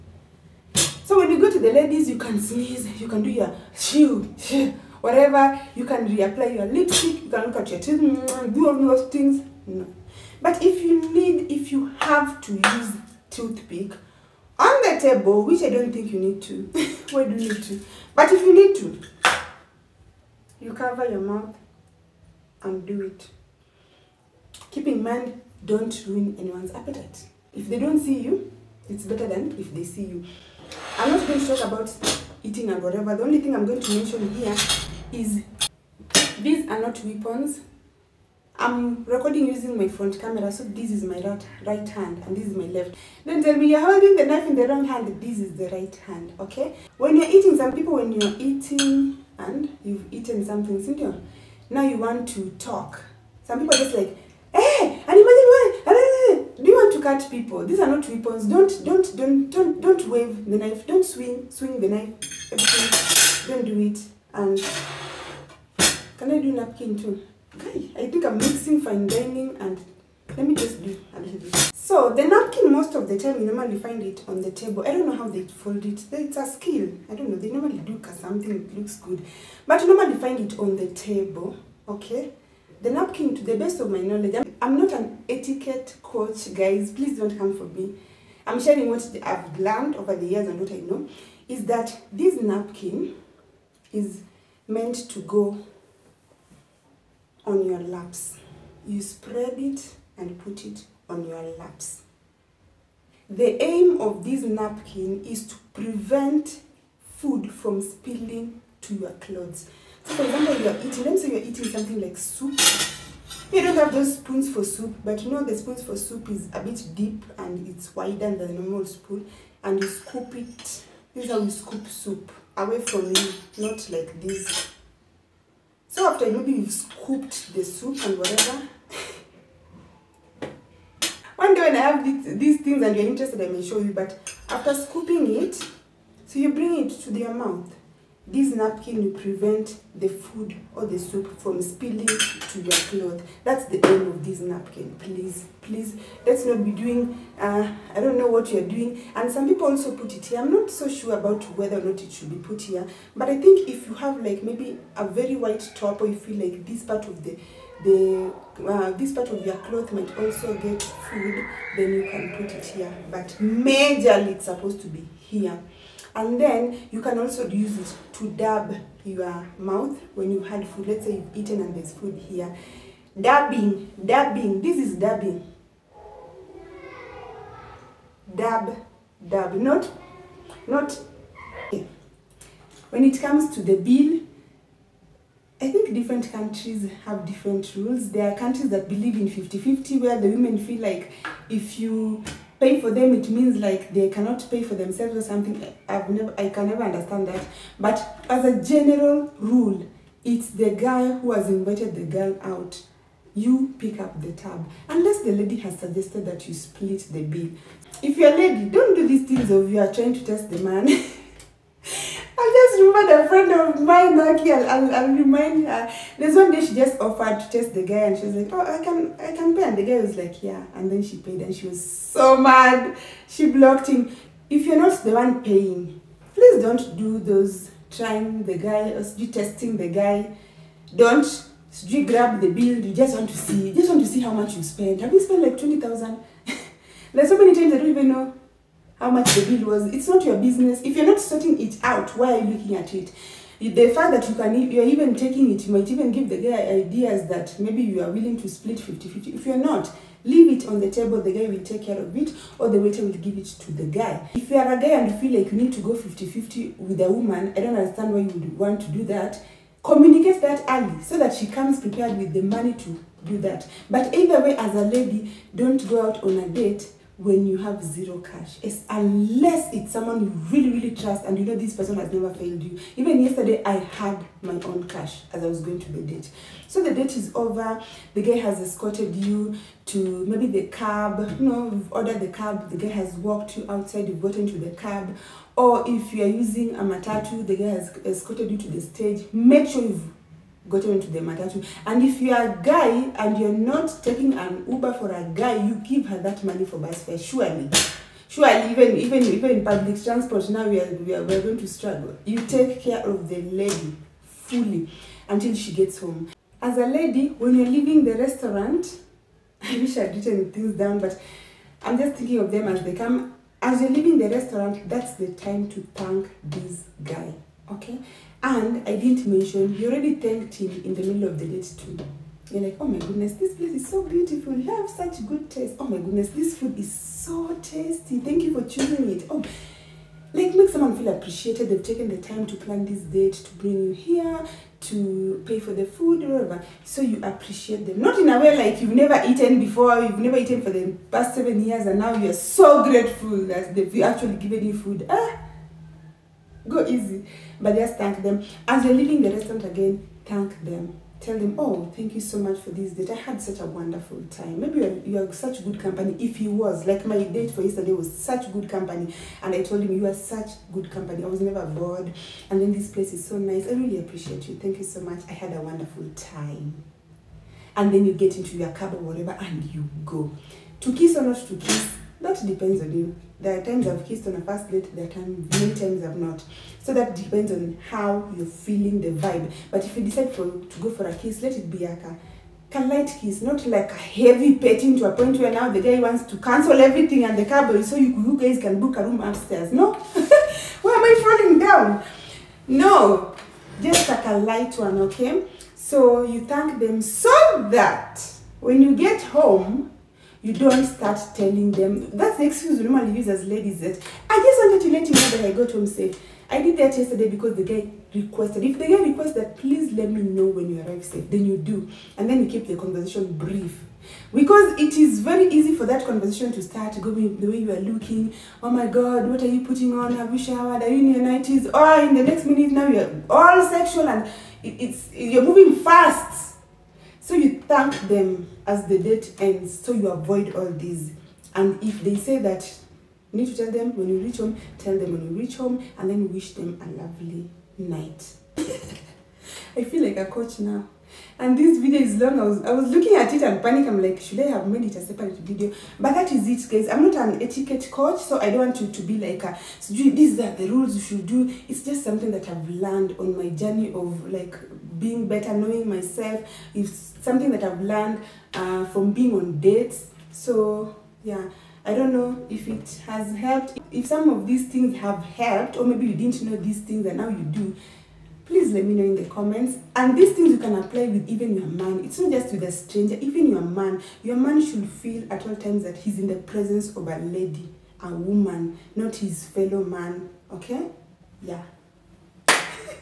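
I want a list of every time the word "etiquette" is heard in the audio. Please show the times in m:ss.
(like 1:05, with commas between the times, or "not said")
1:25, 7:27.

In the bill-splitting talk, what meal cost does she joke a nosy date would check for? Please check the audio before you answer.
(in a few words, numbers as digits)
20,000.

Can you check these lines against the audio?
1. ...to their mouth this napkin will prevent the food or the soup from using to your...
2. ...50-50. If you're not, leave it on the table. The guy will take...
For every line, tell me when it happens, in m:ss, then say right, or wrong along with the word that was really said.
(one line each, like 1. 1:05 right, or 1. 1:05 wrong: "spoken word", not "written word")
1. 2:17 wrong: "spilling", not "using"
2. 4:08 right.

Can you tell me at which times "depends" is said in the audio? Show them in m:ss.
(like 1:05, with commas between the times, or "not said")
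6:12, 6:17.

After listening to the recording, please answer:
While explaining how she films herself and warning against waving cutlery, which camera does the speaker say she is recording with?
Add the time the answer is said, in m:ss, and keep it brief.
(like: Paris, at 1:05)
front camera, at 0:39.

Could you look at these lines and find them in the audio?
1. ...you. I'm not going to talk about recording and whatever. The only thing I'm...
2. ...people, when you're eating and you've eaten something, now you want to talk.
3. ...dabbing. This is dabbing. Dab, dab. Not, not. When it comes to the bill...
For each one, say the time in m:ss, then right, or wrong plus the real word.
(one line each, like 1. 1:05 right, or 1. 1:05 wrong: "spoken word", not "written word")
1. 0:30 wrong: "eating", not "recording"
2. 0:47 right
3. 2:54 right.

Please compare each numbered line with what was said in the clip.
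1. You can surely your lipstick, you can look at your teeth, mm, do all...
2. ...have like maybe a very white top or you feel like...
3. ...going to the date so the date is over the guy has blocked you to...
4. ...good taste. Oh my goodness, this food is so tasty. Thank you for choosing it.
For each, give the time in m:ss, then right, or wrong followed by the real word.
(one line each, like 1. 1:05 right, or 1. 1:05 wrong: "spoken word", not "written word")
1. 0:05 wrong: "reapply", not "surely"
2. 2:33 right
3. 4:35 wrong: "escorted", not "blocked"
4. 5:25 right.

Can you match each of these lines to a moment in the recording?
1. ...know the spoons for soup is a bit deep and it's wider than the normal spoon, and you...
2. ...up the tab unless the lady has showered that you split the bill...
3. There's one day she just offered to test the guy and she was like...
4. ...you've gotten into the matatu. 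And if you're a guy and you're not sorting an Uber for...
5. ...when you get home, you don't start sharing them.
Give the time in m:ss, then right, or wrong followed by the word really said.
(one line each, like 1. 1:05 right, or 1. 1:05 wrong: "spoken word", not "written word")
1. 1:55 right
2. 3:23 wrong: "suggested", not "showered"
3. 3:36 right
4. 4:49 wrong: "taking", not "sorting"
5. 6:38 wrong: "telling", not "sharing".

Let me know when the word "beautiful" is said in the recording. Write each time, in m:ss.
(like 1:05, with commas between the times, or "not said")
5:24.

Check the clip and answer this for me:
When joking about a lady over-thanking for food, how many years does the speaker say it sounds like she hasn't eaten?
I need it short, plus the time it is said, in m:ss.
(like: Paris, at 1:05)
7, at 5:41.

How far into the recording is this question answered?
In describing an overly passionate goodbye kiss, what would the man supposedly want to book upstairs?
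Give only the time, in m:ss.
6:28.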